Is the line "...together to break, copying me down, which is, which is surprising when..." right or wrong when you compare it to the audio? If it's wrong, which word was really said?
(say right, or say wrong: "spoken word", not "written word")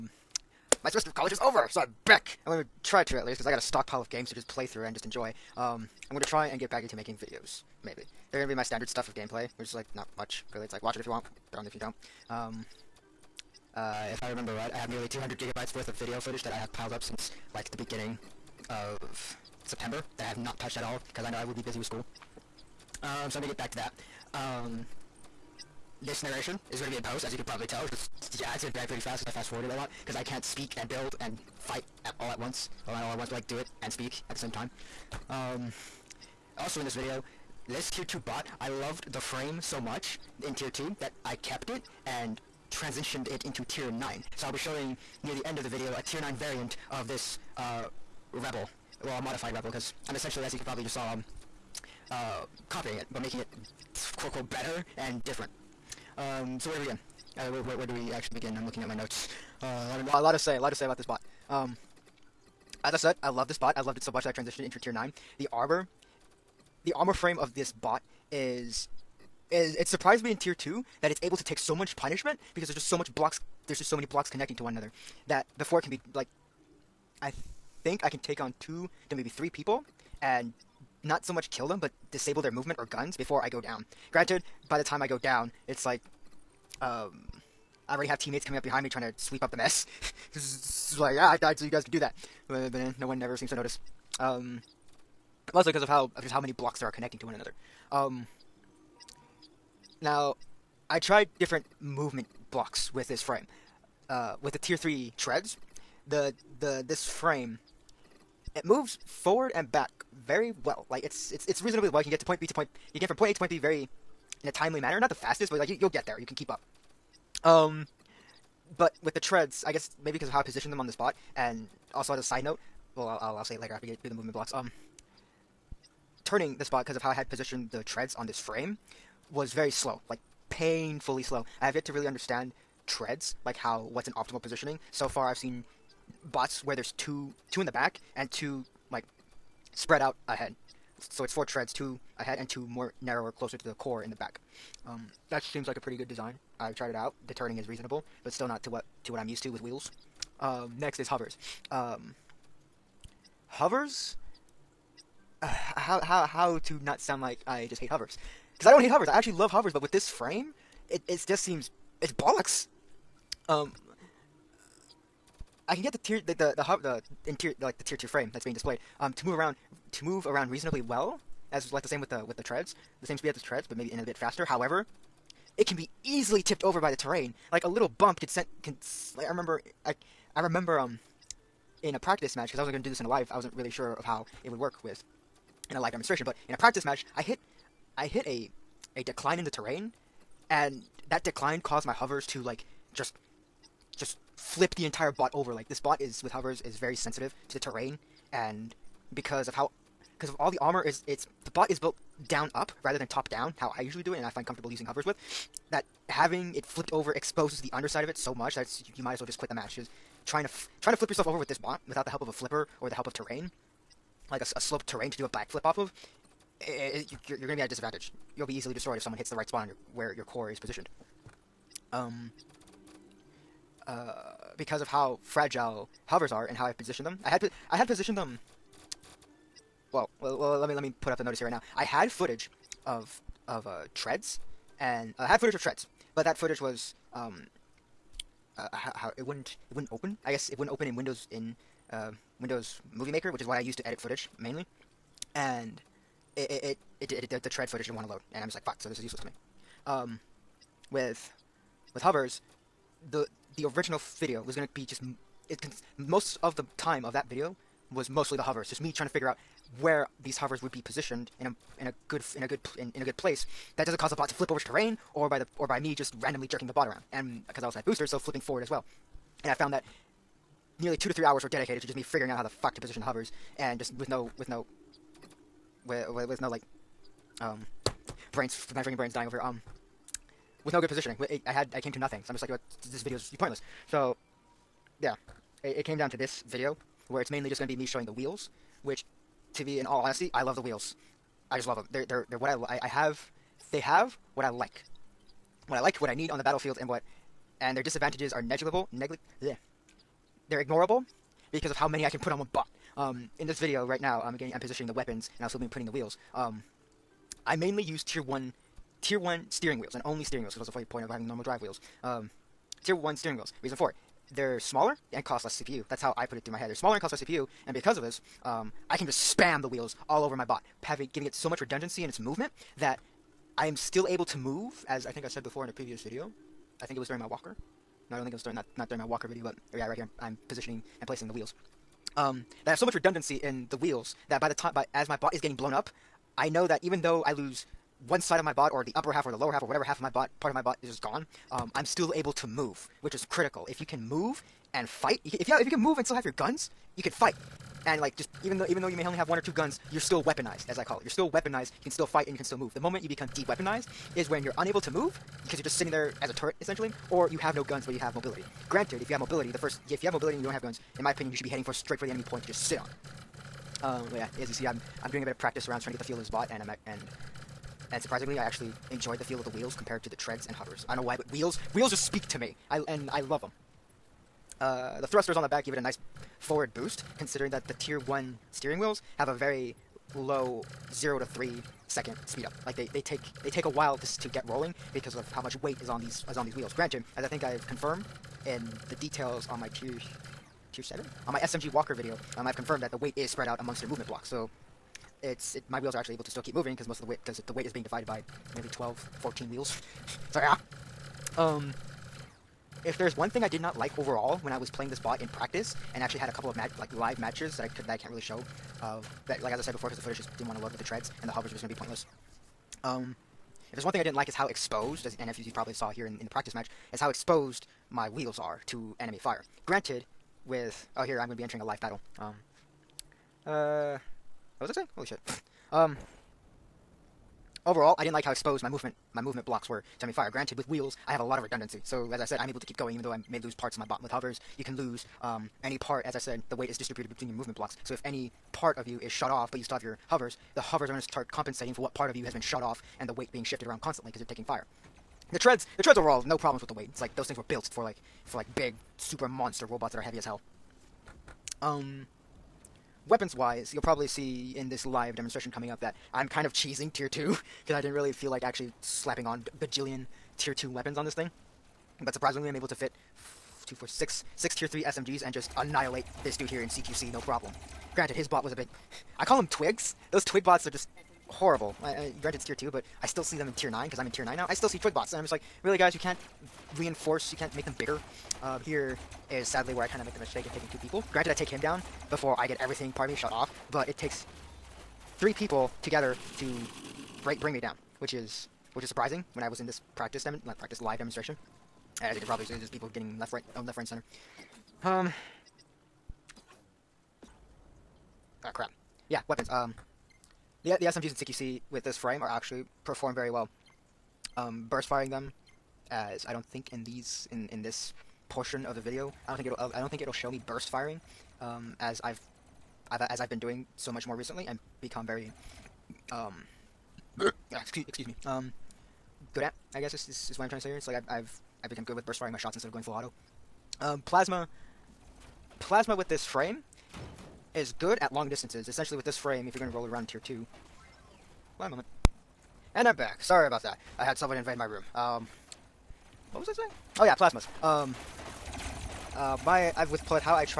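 wrong: "bring", not "copying".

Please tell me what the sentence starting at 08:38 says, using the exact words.
Um, good at, I guess is, is, is what I'm trying to say here.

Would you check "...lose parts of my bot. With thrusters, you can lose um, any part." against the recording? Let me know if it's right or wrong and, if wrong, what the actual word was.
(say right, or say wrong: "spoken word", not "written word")
wrong: "hovers", not "thrusters".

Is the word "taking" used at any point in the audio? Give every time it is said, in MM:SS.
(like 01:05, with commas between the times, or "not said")
07:24, 08:00.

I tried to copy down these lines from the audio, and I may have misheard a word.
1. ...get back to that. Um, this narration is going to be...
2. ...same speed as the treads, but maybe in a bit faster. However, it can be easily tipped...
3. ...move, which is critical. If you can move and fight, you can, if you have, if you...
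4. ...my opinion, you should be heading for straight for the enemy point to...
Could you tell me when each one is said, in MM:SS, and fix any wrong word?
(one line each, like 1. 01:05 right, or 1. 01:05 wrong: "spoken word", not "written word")
1. 00:23 right
2. 02:53 right
3. 05:42 right
4. 06:01 right.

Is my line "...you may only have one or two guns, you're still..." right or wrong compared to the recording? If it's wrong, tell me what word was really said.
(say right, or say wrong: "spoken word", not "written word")
right.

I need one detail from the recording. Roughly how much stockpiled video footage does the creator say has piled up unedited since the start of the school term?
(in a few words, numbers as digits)
200 gigabytes.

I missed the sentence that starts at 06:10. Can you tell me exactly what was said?
I don't know why, but wheels wheels just speak to me.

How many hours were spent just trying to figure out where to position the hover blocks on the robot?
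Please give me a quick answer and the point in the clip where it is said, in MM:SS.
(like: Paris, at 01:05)
2 to 3 hours, at 04:30.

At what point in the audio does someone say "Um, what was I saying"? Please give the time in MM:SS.
08:54.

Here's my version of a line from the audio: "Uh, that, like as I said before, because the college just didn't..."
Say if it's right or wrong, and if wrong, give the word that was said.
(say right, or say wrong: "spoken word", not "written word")
wrong: "footage", not "college".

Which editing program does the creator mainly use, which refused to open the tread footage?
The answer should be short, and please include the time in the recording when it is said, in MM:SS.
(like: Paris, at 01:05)
Windows Movie Maker, at 04:02.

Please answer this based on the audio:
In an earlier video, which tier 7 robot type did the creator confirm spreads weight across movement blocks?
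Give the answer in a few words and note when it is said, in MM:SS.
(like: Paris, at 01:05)
SMG Walker, at 06:31.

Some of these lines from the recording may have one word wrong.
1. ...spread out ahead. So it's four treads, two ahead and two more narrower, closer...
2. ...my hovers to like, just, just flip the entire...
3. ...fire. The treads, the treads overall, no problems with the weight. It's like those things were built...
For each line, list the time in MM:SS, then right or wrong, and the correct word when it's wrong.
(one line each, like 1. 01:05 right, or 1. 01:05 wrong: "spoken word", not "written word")
1. 02:19 right
2. 03:11 right
3. 07:24 right.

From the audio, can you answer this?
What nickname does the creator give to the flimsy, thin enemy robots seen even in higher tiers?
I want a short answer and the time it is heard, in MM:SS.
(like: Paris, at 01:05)
twigs, at 07:49.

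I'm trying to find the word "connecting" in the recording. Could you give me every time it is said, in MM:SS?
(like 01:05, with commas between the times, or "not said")
01:14, 01:36.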